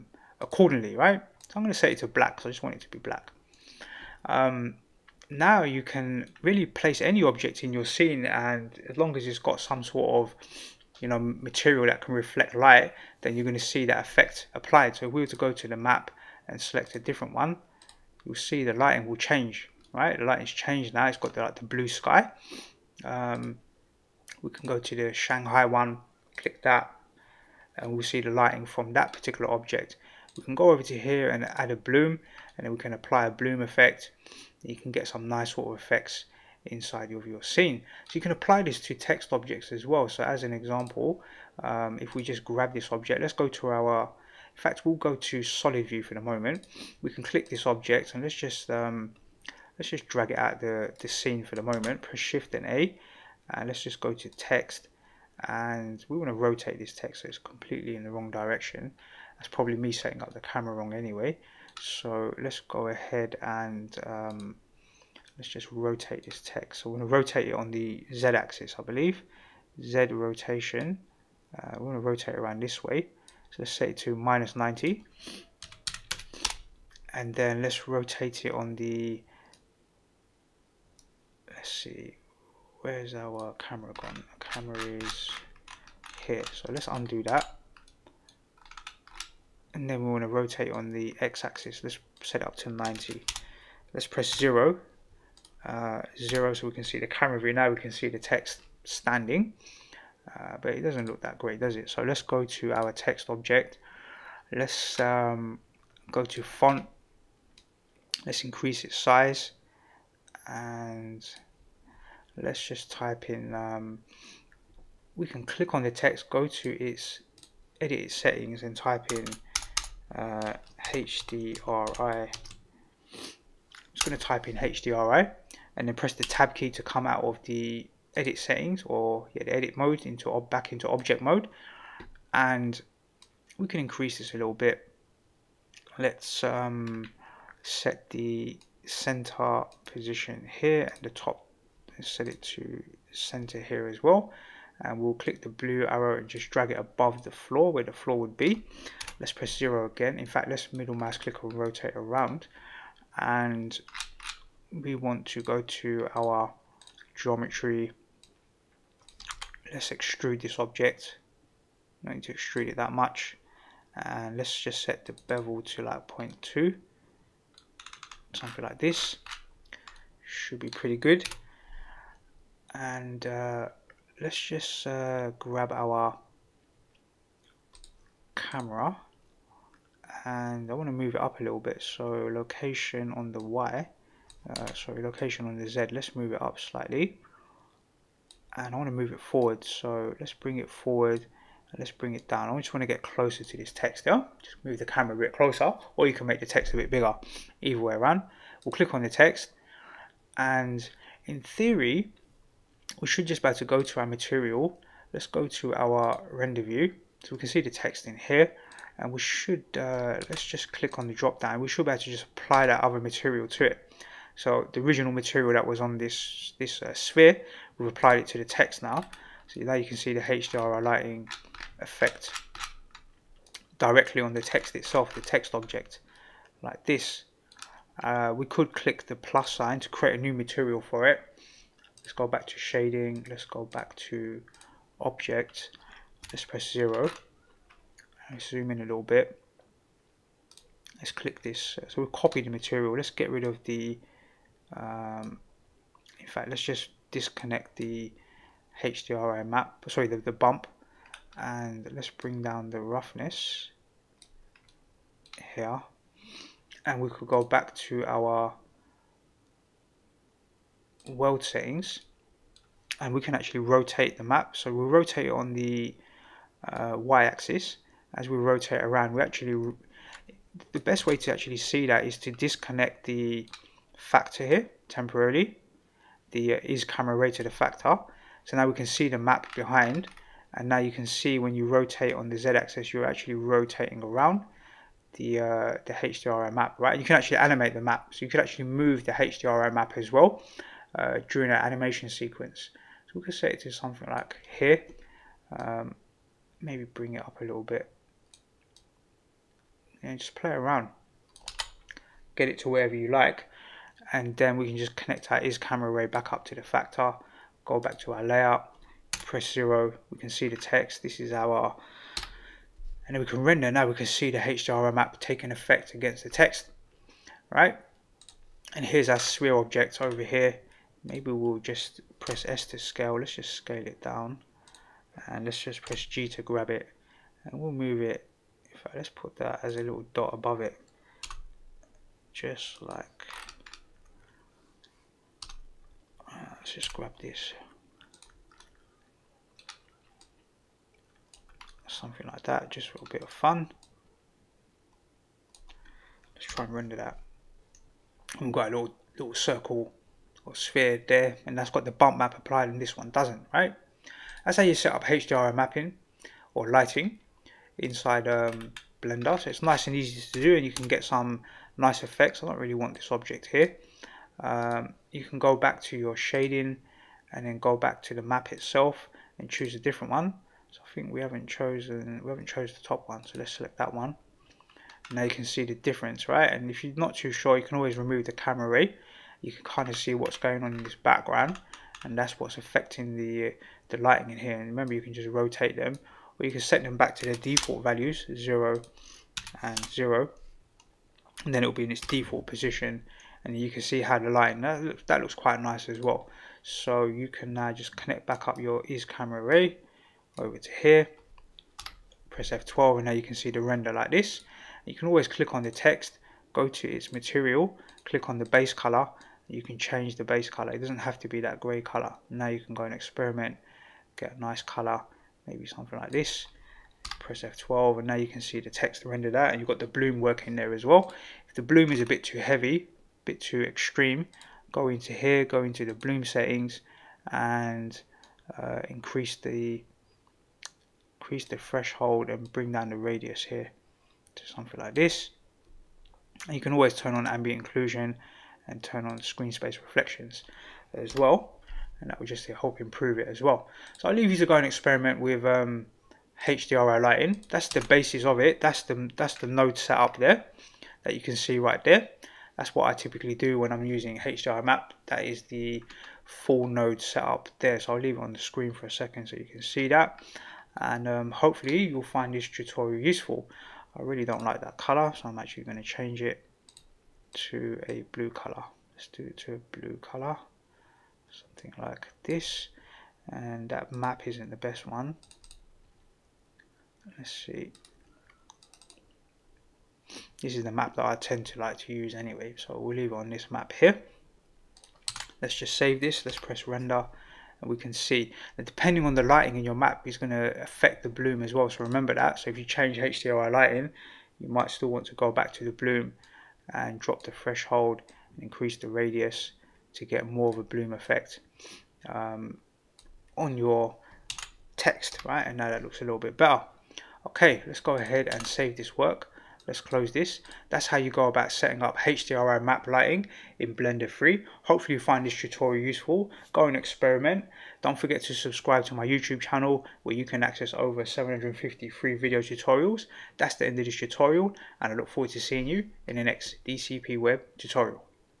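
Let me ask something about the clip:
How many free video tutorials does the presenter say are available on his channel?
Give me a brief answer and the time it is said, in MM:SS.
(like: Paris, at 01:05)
over 750, at 08:40.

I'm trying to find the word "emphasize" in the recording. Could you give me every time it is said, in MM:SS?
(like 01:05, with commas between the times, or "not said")
not said.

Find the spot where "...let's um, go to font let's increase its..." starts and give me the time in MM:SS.
01:44.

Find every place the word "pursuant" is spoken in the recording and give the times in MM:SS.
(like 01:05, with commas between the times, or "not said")
not said.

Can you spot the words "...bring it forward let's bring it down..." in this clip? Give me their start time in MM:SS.
03:10.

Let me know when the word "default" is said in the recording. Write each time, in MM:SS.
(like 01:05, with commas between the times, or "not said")
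06:27, 06:32.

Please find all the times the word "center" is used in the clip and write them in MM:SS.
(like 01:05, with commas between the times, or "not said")
02:18, 02:23.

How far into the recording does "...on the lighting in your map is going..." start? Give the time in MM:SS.
08:09.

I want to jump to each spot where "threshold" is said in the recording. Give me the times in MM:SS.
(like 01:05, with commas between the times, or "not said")
07:11, 08:17.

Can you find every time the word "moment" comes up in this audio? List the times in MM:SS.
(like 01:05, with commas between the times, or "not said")
00:46, 00:51.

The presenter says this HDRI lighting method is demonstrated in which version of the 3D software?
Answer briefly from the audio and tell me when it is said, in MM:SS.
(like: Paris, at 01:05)
Blender 3, at 08:33.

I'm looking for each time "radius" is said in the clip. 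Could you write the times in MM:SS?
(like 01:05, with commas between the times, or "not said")
07:12, 08:18.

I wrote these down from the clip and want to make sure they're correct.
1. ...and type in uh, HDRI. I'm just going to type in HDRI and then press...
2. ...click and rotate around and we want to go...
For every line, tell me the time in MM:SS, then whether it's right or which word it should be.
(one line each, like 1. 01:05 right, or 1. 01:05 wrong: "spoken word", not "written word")
1. 01:58 right
2. 02:31 right.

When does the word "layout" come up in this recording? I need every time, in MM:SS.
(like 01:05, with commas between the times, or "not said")
05:08.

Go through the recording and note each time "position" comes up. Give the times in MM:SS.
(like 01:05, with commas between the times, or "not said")
02:19, 06:32.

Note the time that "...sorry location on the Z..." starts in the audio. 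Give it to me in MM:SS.
03:04.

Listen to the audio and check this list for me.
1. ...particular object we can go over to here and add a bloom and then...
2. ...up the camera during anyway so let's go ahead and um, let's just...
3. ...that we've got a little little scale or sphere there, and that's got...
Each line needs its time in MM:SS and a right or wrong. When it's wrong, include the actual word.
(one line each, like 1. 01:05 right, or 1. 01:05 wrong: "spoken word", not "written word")
1. 00:29 right
2. 01:00 wrong: "wrong", not "during"
3. 05:46 wrong: "circle", not "scale".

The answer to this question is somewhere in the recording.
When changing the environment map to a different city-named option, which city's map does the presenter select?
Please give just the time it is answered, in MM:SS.
00:25.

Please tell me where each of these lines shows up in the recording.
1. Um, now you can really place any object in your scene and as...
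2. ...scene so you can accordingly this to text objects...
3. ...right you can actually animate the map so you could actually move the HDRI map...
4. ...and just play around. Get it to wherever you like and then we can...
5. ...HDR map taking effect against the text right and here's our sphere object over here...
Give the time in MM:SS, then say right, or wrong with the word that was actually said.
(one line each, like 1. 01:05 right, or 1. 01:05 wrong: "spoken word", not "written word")
1. 00:04 right
2. 00:37 wrong: "apply", not "accordingly"
3. 04:46 right
4. 05:00 right
5. 05:14 right.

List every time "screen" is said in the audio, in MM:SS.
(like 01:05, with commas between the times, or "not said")
07:19, 07:38.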